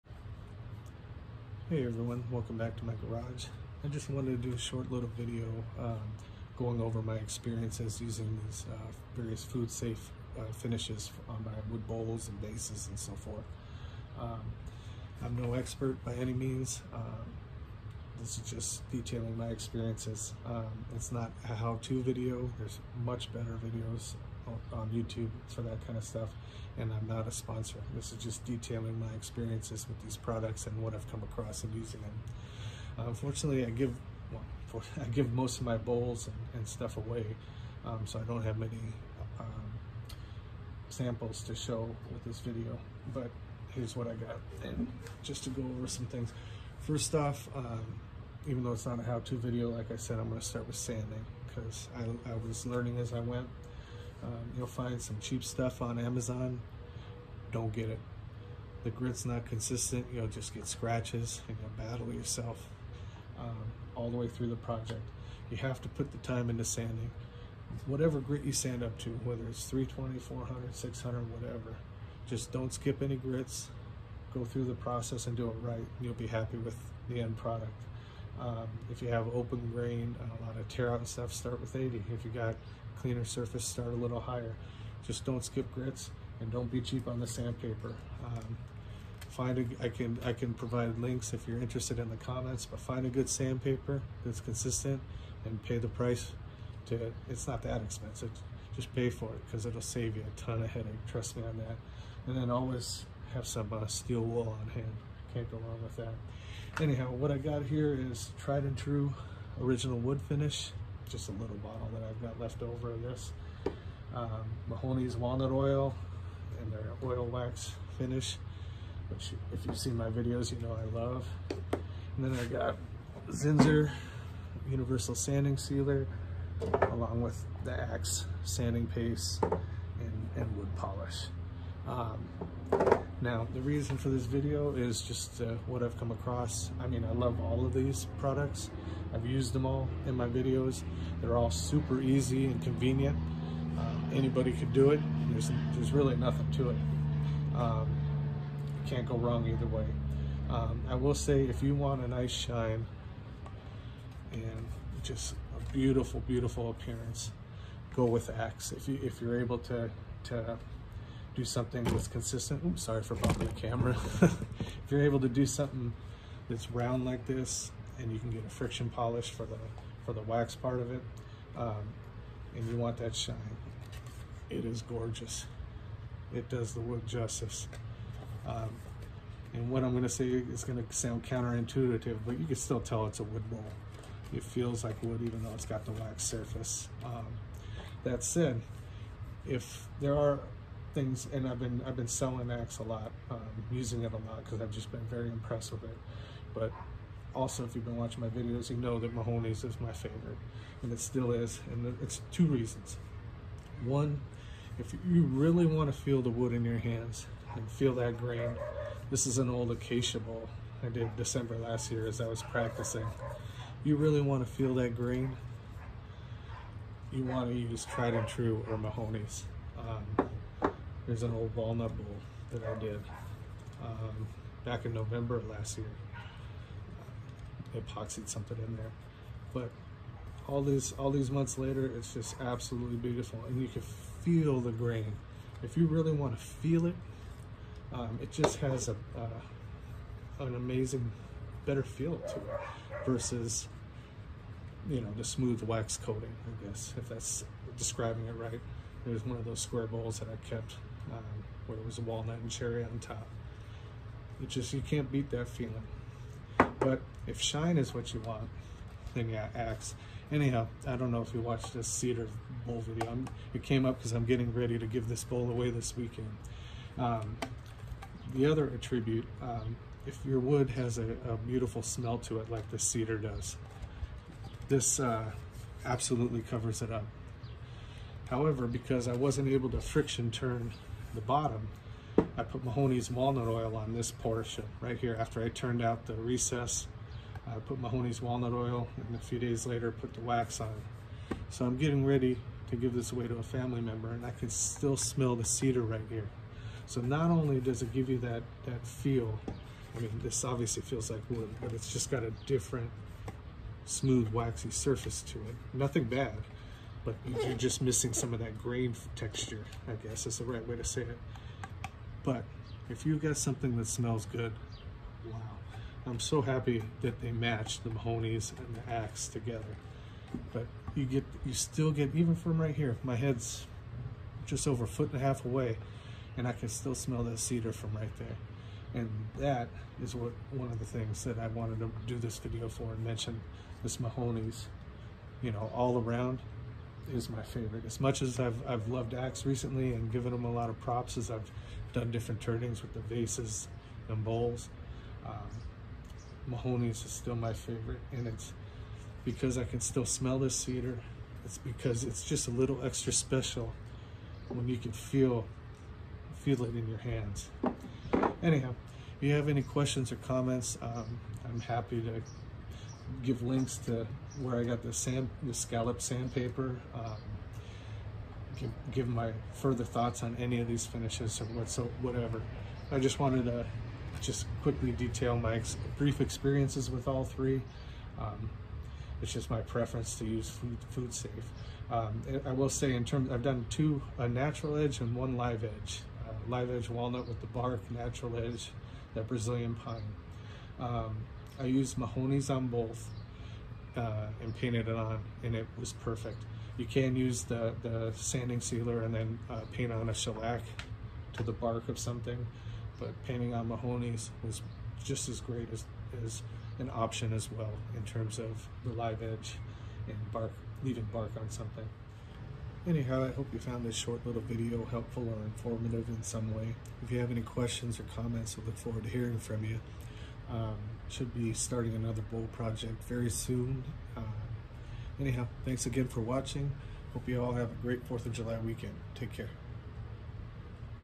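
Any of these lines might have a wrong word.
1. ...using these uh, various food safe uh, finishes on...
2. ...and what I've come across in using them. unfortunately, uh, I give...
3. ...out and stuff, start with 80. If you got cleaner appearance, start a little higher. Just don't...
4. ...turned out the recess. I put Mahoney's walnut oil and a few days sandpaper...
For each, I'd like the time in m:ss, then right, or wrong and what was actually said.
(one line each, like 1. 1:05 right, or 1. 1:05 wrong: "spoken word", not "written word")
1. 0:08 right
2. 0:30 right
3. 1:20 wrong: "surface", not "appearance"
4. 4:45 wrong: "later", not "sandpaper".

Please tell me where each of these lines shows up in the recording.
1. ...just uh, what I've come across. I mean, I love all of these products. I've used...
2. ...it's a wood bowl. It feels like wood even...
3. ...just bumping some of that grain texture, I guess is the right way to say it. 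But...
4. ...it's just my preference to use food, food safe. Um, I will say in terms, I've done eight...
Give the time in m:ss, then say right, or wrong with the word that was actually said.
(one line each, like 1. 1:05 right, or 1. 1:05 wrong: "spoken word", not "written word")
1. 2:15 right
2. 3:03 right
3. 5:07 wrong: "missing", not "bumping"
4. 6:19 wrong: "two", not "eight".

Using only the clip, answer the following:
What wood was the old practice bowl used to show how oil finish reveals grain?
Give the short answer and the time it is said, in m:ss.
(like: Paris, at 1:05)
Acacia, at 3:29.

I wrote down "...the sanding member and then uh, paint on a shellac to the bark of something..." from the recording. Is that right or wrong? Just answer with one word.
wrong.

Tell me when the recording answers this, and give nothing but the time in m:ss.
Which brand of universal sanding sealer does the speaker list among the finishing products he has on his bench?
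2:03.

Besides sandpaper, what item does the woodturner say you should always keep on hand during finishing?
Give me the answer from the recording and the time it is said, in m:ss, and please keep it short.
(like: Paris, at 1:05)
Steel wool, at 1:43.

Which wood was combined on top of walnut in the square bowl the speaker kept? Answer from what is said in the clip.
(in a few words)
Cherry.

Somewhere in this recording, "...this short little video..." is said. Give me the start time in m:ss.
6:53.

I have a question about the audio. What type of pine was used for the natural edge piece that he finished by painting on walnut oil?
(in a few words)
Brazilian pine.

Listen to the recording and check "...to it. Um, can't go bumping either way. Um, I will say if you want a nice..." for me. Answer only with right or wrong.
wrong.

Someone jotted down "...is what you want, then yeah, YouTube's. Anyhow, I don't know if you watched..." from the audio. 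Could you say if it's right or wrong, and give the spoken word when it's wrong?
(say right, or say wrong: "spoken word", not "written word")
wrong: "Ack", not "YouTube".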